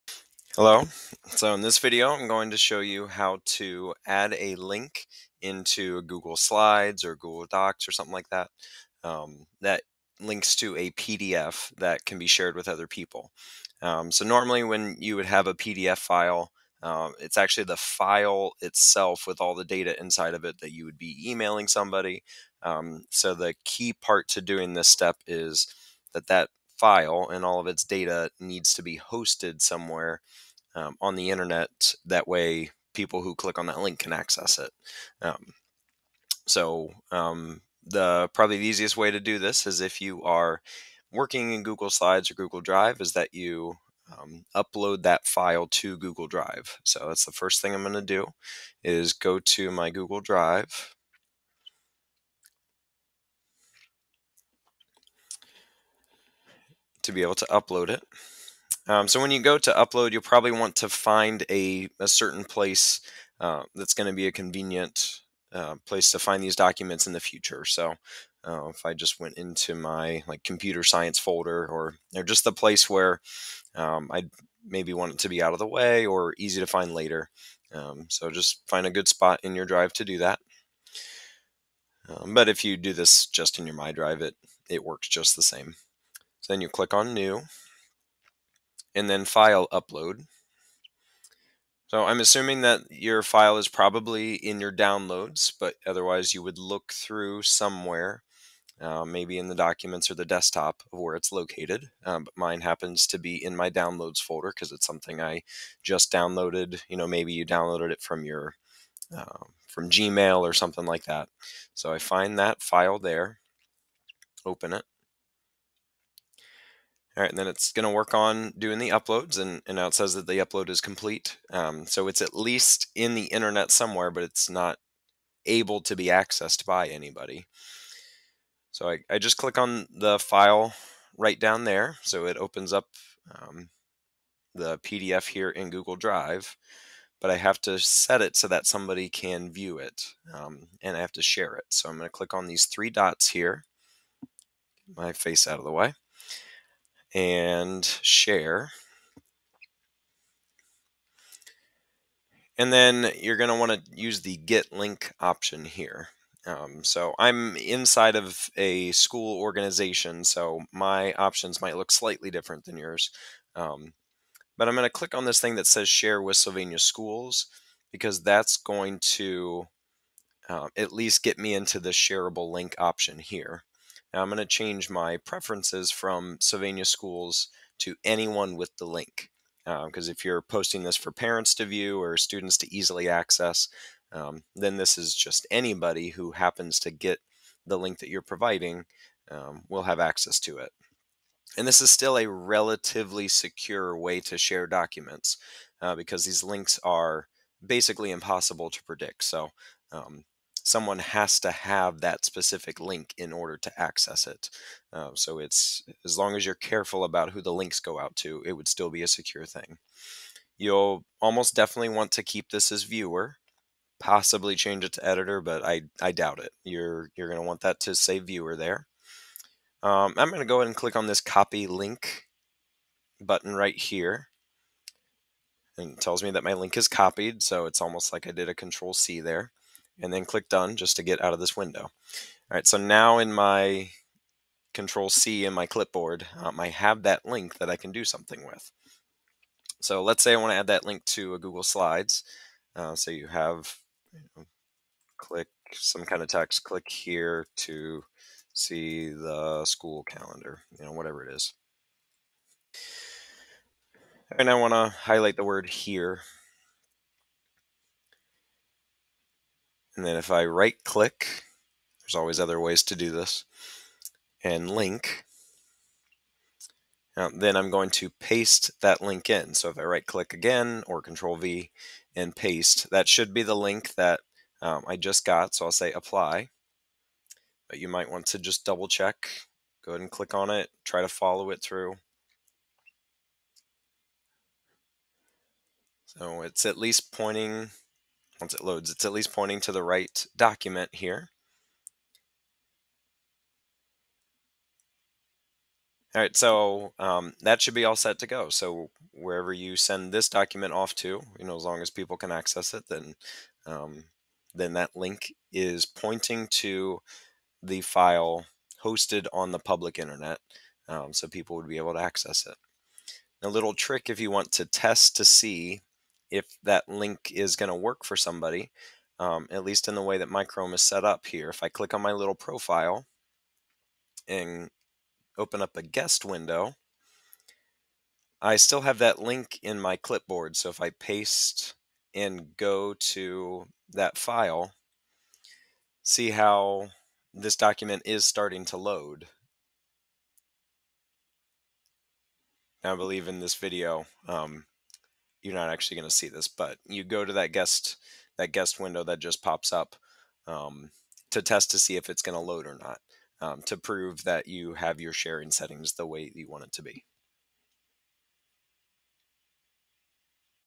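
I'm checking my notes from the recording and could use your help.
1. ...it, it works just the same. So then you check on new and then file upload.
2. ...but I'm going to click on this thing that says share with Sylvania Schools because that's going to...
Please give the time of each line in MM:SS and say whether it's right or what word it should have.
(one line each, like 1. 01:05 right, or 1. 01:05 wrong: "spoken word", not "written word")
1. 01:24 wrong: "click", not "check"
2. 02:44 right.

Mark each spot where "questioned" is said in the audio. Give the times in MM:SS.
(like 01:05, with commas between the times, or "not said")
not said.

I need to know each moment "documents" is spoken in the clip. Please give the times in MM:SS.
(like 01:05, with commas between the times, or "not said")
01:06, 01:39, 03:14, 04:50, 05:00, 05:37.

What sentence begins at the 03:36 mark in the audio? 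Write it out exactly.
You're, you're going to want that to say viewer there.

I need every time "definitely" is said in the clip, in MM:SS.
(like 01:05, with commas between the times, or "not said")
03:31.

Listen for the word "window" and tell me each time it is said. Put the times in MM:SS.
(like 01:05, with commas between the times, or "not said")
03:51, 05:26, 05:48.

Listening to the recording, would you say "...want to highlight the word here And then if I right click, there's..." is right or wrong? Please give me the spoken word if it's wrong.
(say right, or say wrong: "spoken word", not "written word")
right.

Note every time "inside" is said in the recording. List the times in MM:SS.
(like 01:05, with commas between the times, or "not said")
00:20, 02:37.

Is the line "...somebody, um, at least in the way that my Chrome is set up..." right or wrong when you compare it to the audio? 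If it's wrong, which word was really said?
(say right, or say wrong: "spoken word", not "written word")
right.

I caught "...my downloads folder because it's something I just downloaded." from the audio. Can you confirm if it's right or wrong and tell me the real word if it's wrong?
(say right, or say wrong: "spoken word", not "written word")
right.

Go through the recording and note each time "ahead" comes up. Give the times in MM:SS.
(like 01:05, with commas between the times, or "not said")
03:40, 04:39.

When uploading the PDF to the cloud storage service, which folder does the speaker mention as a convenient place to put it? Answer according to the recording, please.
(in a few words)
computer science folder.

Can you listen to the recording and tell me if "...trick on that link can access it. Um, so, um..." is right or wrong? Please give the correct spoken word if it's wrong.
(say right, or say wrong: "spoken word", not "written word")
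wrong: "click", not "trick".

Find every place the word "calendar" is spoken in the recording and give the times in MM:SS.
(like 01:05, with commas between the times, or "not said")
04:10.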